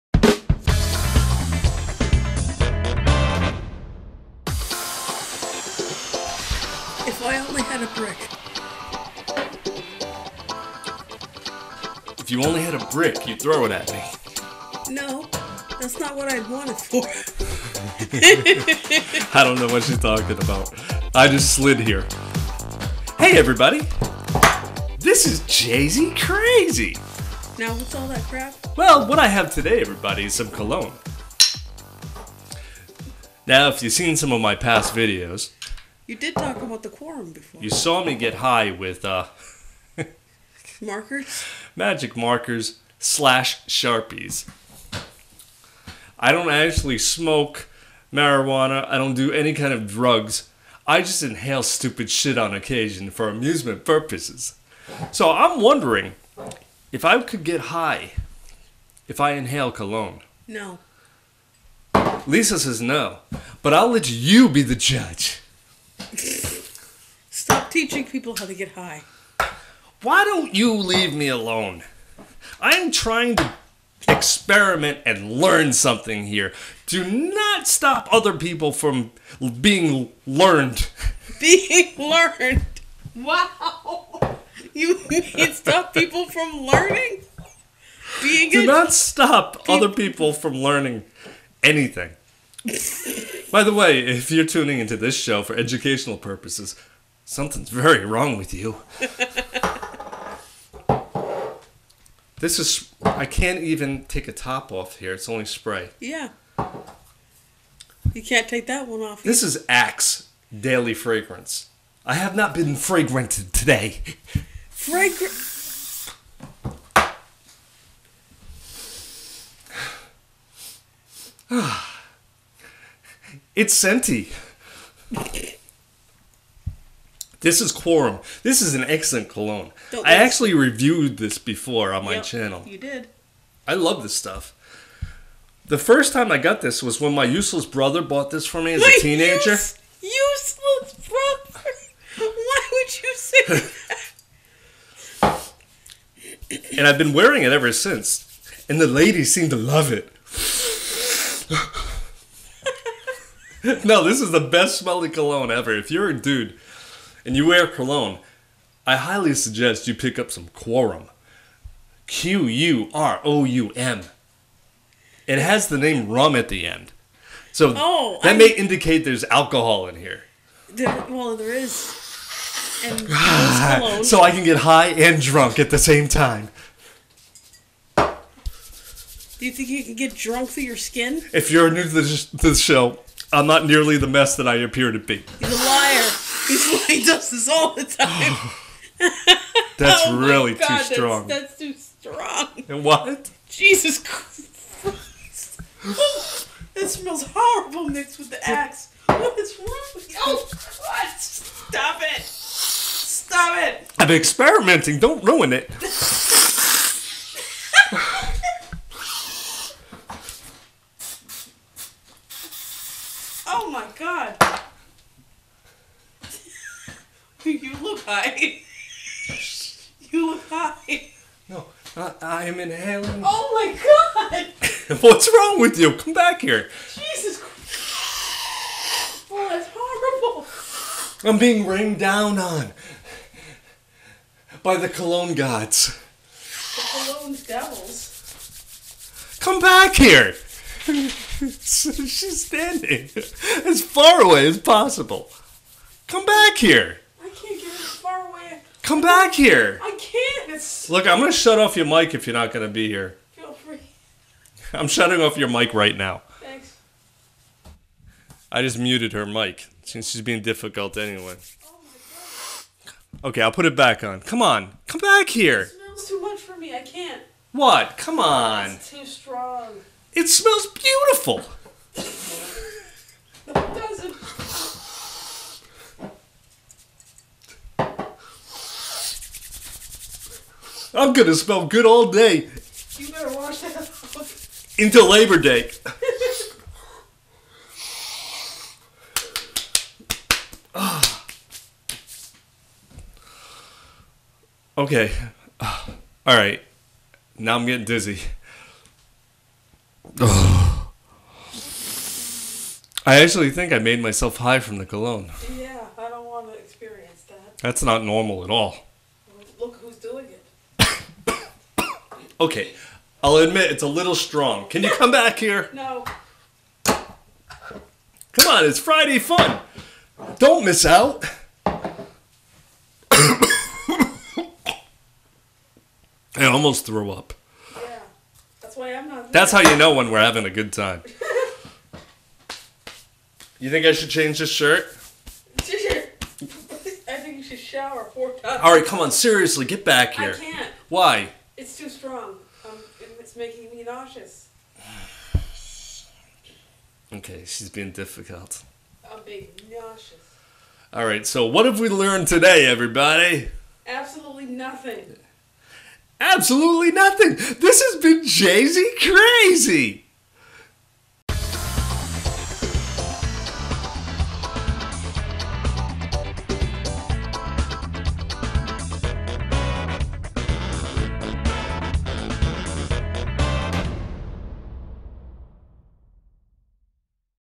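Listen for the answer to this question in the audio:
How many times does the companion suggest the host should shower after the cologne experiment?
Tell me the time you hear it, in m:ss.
5:38.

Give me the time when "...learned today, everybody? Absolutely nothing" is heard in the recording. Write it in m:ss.
5:51.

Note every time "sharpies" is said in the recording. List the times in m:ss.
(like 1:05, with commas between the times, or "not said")
0:43.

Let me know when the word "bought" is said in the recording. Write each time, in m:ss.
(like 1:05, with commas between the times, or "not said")
2:18.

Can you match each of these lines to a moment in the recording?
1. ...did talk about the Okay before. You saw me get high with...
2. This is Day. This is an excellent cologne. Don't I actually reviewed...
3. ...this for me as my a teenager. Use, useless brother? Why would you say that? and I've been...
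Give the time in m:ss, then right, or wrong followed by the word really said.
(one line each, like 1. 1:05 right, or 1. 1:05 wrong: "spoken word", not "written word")
1. 0:36 wrong: "Quorum", not "Okay"
2. 2:07 wrong: "Quorum", not "Day"
3. 2:18 right.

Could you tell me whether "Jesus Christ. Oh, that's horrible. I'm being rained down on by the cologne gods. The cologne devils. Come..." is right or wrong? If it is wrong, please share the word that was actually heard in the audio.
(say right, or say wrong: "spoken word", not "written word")
right.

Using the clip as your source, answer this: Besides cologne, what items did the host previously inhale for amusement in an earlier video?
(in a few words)
Magic markers.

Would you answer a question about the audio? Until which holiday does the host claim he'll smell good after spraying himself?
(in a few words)
Labor Day.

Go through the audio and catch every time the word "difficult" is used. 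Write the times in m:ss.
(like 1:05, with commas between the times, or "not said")
4:20, 5:47.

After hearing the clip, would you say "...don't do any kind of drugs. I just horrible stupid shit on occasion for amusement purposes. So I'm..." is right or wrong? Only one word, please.
wrong.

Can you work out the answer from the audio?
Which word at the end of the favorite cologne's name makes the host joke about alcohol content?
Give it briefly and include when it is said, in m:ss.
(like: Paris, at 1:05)
Rum, at 2:46.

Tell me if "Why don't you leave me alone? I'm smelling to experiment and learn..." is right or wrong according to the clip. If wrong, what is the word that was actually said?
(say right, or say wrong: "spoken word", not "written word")
wrong: "trying", not "smelling".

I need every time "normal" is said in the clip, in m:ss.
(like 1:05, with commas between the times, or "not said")
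5:08.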